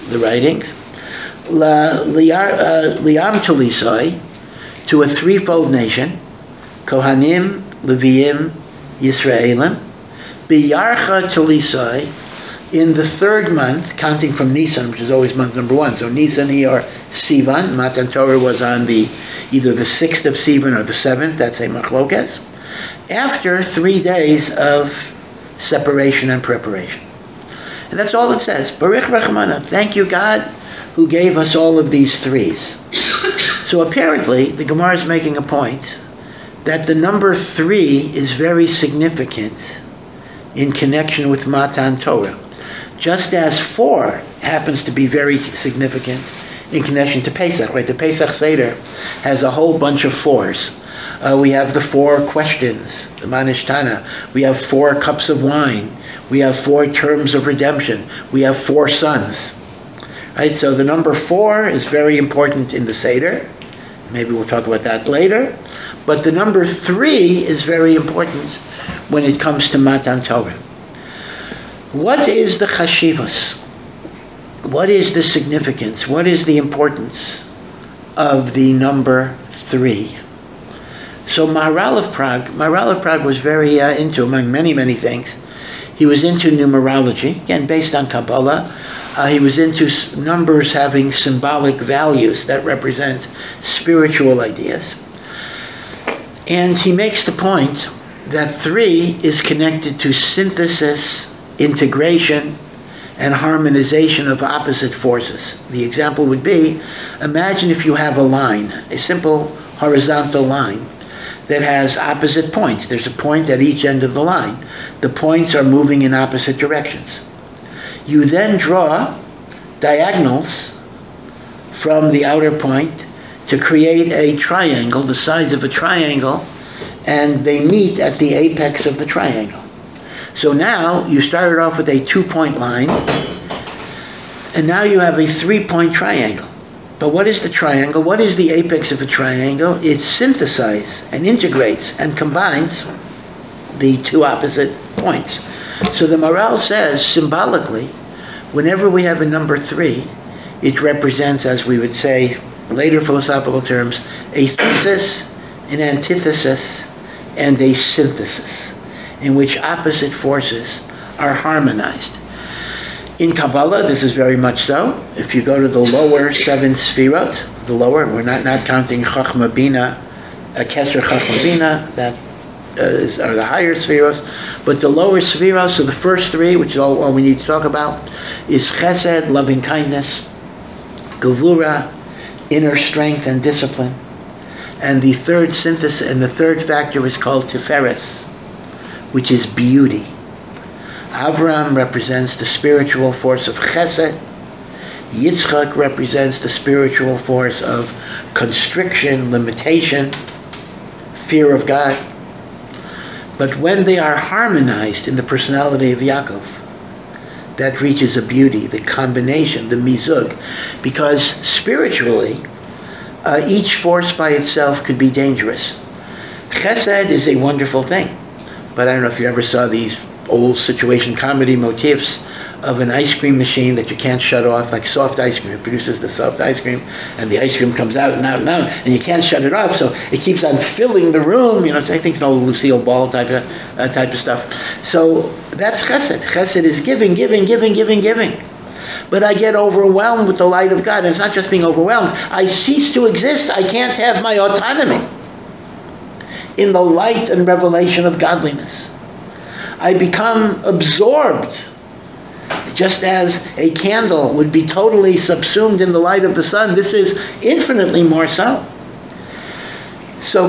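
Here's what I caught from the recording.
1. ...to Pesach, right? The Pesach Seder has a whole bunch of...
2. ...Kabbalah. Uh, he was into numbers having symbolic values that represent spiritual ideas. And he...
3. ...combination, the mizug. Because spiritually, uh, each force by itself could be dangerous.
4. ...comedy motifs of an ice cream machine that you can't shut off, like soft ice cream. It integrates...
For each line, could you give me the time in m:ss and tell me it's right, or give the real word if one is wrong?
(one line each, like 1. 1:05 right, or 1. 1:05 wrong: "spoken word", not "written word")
1. 0:47 right
2. 1:28 right
3. 3:28 right
4. 3:41 wrong: "produces", not "integrates".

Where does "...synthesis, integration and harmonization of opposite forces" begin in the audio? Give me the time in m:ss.
1:40.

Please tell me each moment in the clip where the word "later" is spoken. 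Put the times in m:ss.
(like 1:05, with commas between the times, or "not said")
1:05, 2:32.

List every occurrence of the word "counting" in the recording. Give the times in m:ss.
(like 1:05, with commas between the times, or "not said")
0:13, 2:48.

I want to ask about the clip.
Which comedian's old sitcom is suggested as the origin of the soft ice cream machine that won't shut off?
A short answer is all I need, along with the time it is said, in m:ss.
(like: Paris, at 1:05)
Lucille Ball, at 3:52.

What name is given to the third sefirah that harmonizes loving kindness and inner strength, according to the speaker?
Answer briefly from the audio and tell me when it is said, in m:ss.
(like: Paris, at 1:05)
Tiferes, at 3:07.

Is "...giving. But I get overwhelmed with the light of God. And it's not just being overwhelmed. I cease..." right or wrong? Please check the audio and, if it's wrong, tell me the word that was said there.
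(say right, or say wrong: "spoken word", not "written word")
right.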